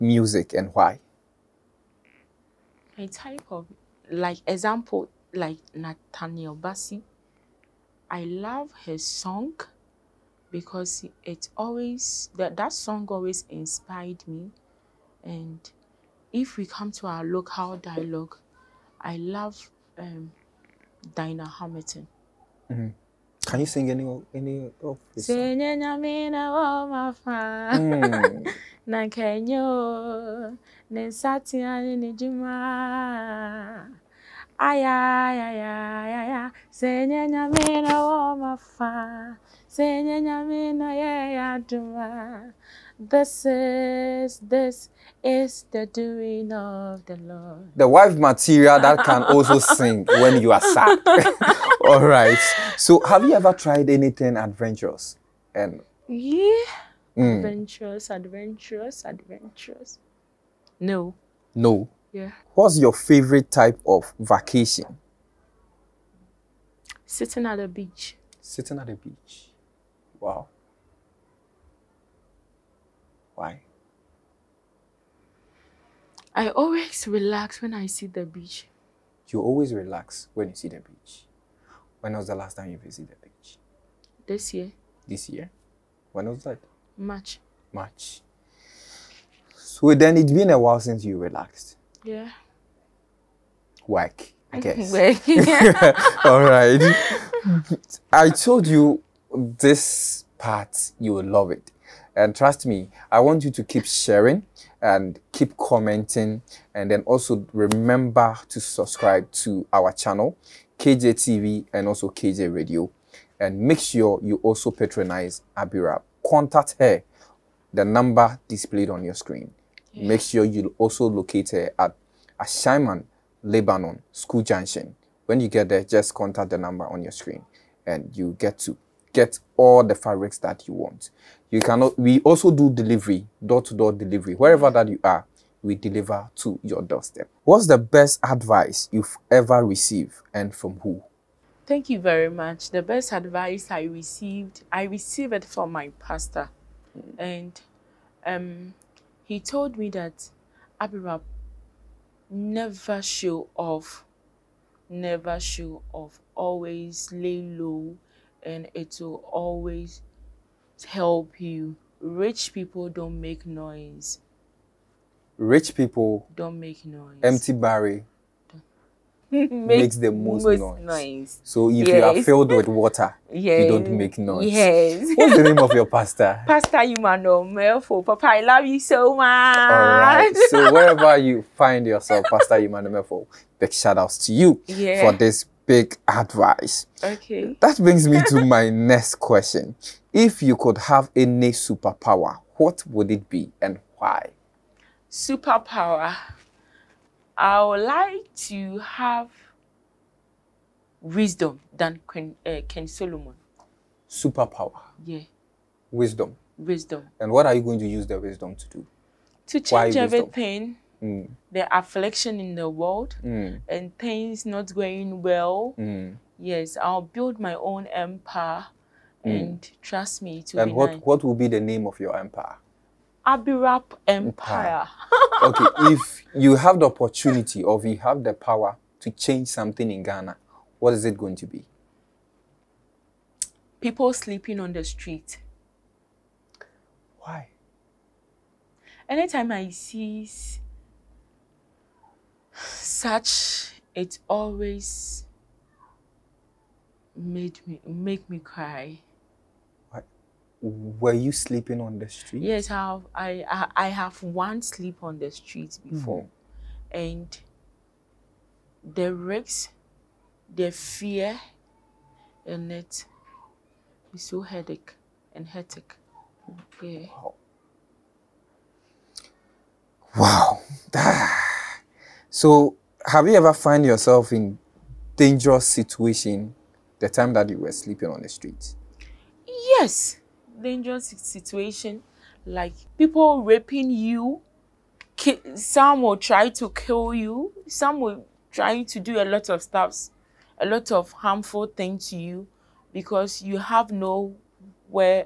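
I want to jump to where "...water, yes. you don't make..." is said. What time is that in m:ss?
2:52.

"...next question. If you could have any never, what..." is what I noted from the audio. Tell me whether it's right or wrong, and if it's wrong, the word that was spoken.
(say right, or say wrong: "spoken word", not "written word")
wrong: "superpower", not "never".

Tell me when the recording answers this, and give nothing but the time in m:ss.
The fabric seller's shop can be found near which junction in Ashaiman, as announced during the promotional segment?
2:03.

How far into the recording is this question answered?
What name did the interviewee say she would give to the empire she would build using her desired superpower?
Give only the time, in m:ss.
3:43.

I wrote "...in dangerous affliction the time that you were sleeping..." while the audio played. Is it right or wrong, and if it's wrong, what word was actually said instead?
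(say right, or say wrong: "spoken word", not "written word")
wrong: "situation", not "affliction".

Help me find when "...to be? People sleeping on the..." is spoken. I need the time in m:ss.
3:51.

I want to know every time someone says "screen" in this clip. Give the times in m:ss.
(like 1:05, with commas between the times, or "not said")
1:59, 2:07.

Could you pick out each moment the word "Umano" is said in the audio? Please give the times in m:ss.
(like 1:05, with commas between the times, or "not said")
2:56, 3:02.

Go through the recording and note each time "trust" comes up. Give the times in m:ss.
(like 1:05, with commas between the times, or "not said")
1:42, 3:39.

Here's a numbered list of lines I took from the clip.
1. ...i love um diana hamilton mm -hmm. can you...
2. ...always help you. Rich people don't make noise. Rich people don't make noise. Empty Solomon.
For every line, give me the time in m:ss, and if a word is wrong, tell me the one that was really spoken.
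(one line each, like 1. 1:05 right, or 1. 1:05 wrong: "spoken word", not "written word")
1. 0:19 right
2. 2:39 wrong: "Barry", not "Solomon".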